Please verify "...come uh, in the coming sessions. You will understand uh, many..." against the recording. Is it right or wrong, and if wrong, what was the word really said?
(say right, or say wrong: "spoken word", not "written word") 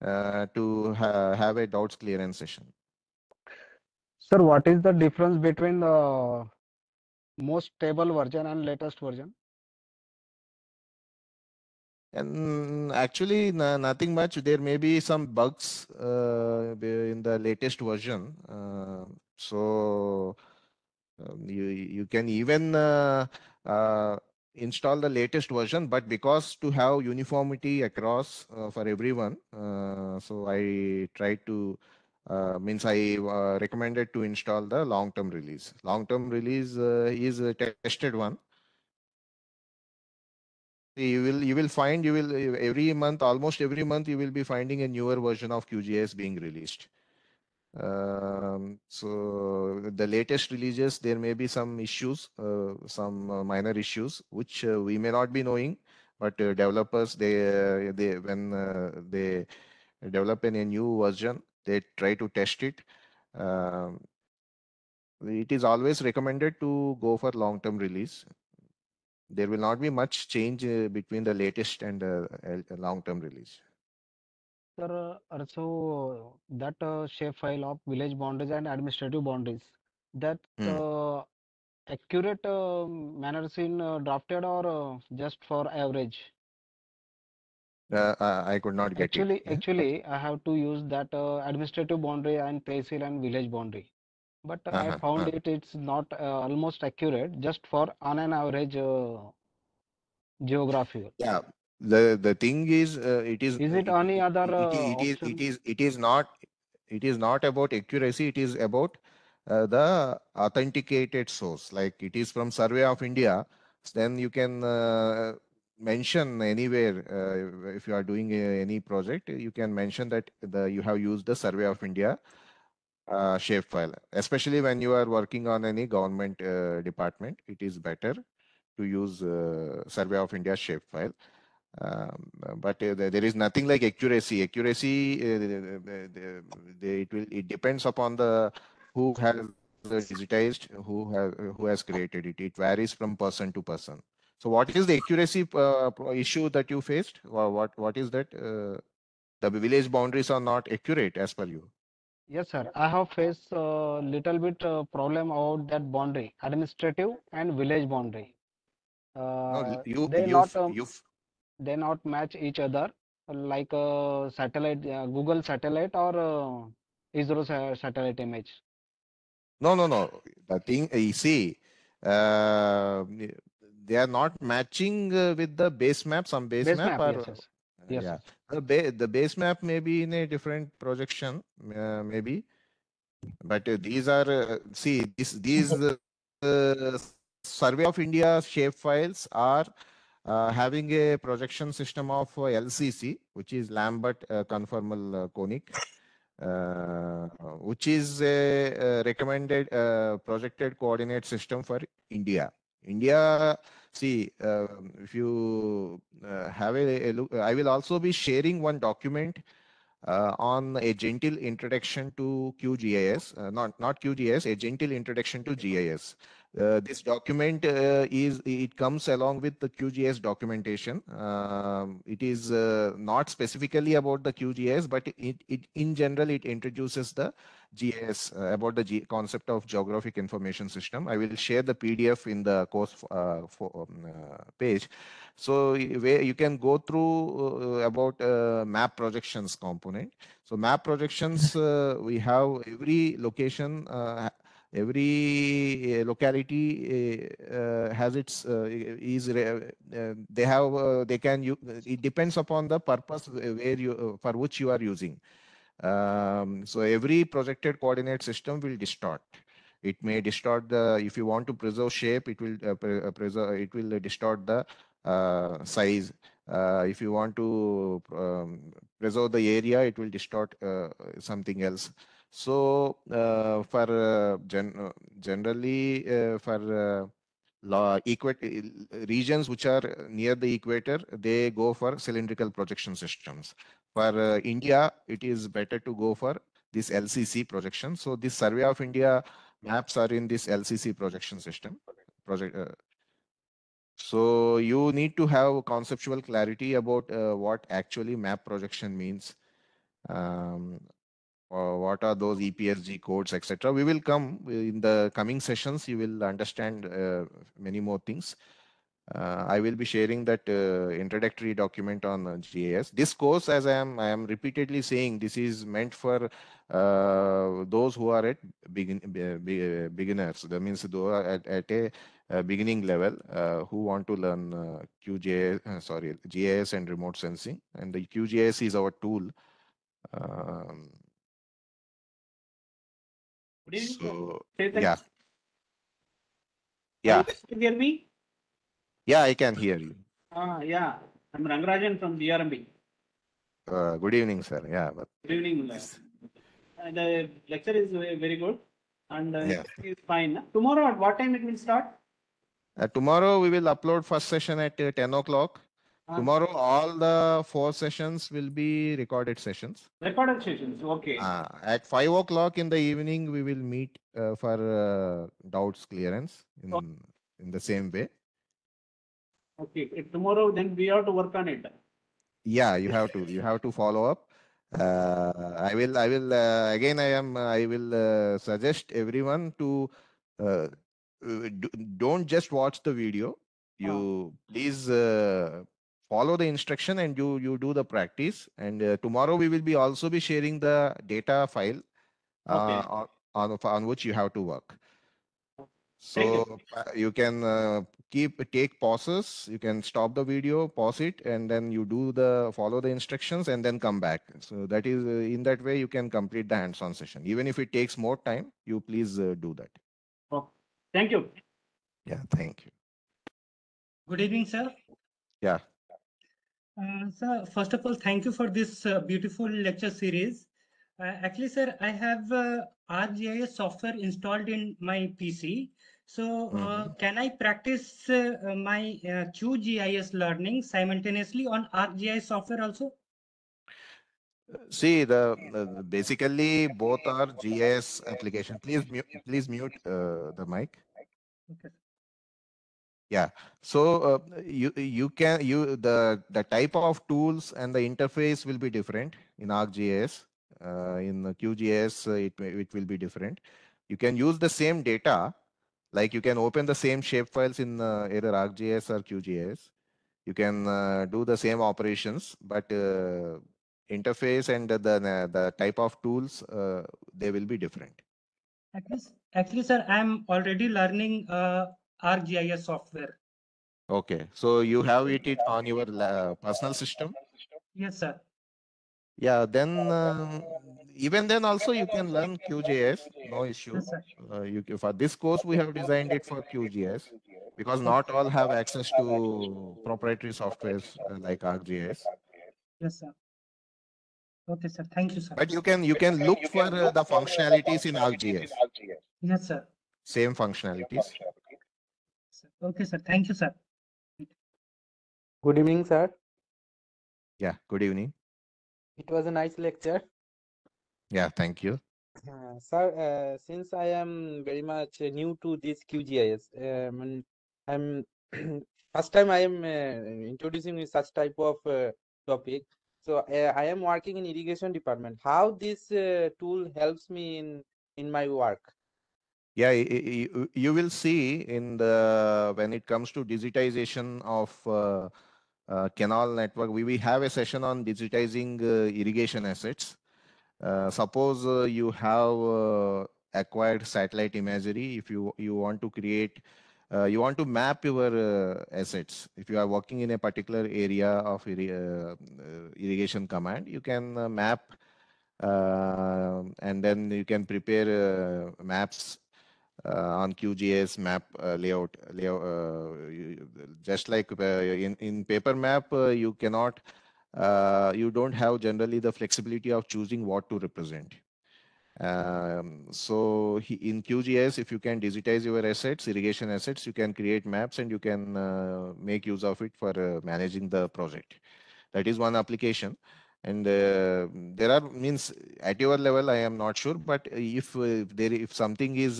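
right.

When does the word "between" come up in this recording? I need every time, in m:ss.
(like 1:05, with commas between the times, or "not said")
0:05, 1:10.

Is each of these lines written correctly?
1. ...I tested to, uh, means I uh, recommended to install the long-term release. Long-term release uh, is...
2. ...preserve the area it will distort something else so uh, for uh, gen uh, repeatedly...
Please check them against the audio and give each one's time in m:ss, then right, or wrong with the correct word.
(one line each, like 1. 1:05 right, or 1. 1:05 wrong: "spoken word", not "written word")
1. 0:30 wrong: "tried", not "tested"
2. 4:28 wrong: "generally", not "repeatedly".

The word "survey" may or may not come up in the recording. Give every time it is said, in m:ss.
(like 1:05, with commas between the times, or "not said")
1:52, 2:01, 2:09, 3:07, 4:48.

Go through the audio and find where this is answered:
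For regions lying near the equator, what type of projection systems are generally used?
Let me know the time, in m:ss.
4:41.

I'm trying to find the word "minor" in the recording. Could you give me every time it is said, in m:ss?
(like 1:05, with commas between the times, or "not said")
0:53.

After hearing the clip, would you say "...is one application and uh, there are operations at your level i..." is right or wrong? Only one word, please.
wrong.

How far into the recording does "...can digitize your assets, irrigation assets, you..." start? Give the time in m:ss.
9:34.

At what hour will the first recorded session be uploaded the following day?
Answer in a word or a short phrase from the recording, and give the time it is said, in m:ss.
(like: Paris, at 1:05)
10 o'clock, at 5:54.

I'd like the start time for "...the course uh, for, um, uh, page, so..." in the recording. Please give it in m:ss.
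3:52.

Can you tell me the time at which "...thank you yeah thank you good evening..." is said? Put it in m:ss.
6:50.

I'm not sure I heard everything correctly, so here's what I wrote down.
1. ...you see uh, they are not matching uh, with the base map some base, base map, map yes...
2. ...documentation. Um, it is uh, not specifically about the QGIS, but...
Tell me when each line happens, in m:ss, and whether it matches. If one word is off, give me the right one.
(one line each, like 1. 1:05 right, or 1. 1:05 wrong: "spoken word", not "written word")
1. 2:50 right
2. 3:40 right.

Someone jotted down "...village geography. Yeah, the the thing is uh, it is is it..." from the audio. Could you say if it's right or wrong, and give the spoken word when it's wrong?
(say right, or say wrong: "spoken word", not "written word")
wrong: "average", not "village".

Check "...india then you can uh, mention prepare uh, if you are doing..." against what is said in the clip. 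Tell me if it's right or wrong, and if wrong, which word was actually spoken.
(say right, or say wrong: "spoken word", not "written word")
wrong: "anywhere", not "prepare".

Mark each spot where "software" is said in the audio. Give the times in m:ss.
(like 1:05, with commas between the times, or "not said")
7:03, 7:12, 7:52, 8:10.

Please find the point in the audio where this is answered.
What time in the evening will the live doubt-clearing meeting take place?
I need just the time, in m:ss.
6:01.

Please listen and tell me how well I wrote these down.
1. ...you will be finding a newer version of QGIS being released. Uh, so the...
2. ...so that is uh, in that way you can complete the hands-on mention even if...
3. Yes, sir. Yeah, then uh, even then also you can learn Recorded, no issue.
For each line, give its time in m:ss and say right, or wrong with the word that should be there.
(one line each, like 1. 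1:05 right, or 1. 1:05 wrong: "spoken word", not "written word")
1. 0:44 right
2. 6:44 wrong: "session", not "mention"
3. 7:57 wrong: "QGIS", not "Recorded".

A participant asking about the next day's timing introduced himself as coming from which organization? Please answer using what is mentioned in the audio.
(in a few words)
GRMB.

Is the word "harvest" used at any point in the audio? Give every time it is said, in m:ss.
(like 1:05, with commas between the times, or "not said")
not said.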